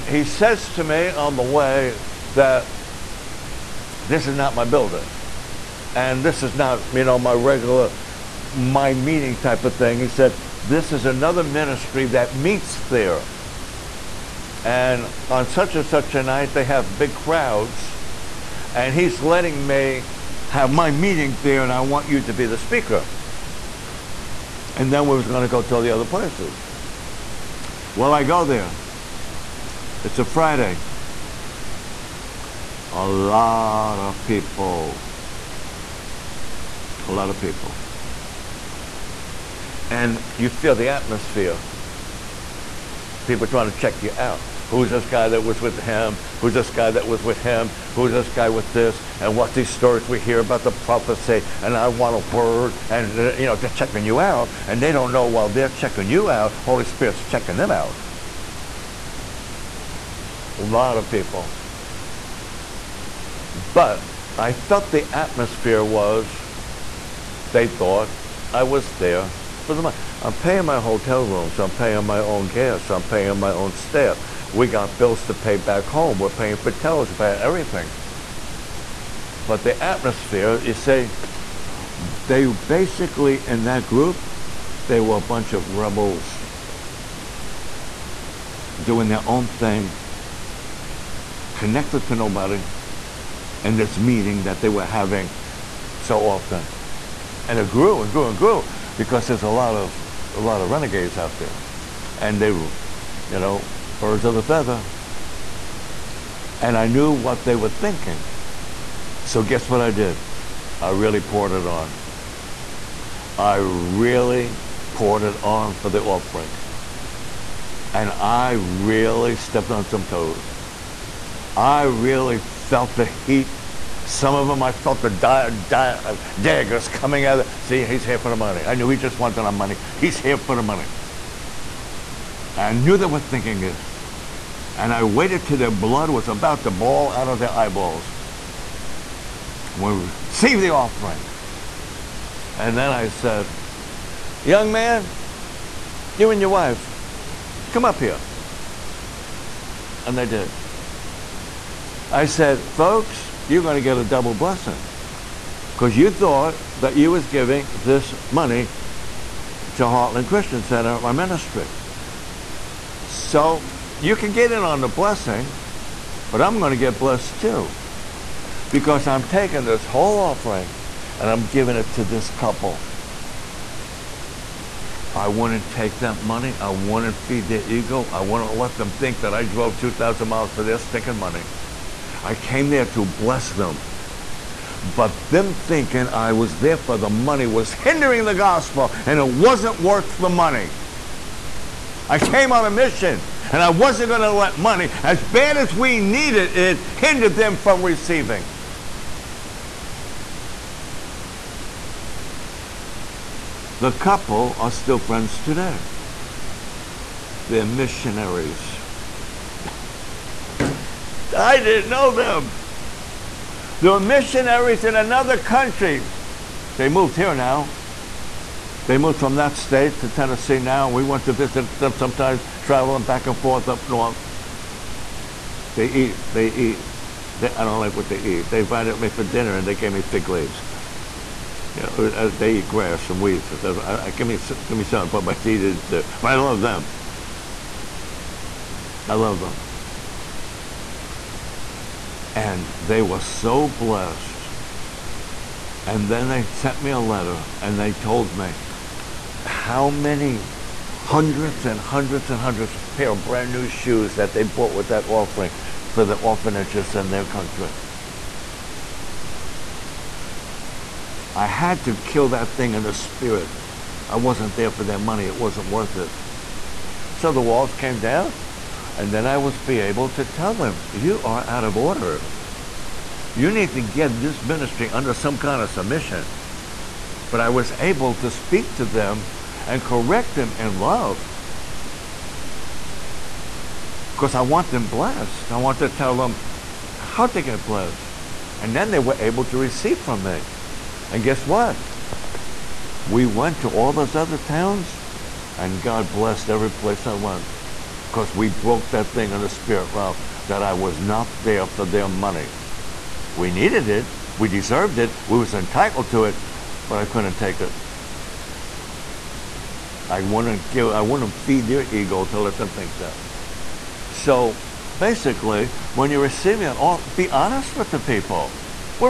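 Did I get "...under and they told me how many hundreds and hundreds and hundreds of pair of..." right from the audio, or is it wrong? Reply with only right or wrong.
wrong.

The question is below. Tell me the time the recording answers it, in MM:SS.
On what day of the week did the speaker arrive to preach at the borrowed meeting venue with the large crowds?
00:30.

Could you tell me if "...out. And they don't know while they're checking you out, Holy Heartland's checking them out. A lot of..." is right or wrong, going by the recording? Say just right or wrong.
wrong.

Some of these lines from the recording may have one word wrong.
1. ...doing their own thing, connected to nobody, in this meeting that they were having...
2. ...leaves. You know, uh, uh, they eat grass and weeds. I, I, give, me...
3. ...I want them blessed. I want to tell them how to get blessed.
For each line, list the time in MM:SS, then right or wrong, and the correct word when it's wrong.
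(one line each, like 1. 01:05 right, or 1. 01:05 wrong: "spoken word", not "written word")
1. 01:28 right
2. 03:50 right
3. 04:44 right.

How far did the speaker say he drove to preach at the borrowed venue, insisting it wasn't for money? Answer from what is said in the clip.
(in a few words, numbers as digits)
2,000 miles.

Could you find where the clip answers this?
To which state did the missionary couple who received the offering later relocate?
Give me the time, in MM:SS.
03:40.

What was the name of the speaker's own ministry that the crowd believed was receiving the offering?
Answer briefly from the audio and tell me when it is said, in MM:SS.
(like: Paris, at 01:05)
Heartland Christian Center, at 02:39.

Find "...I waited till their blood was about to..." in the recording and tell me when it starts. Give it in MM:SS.
02:14.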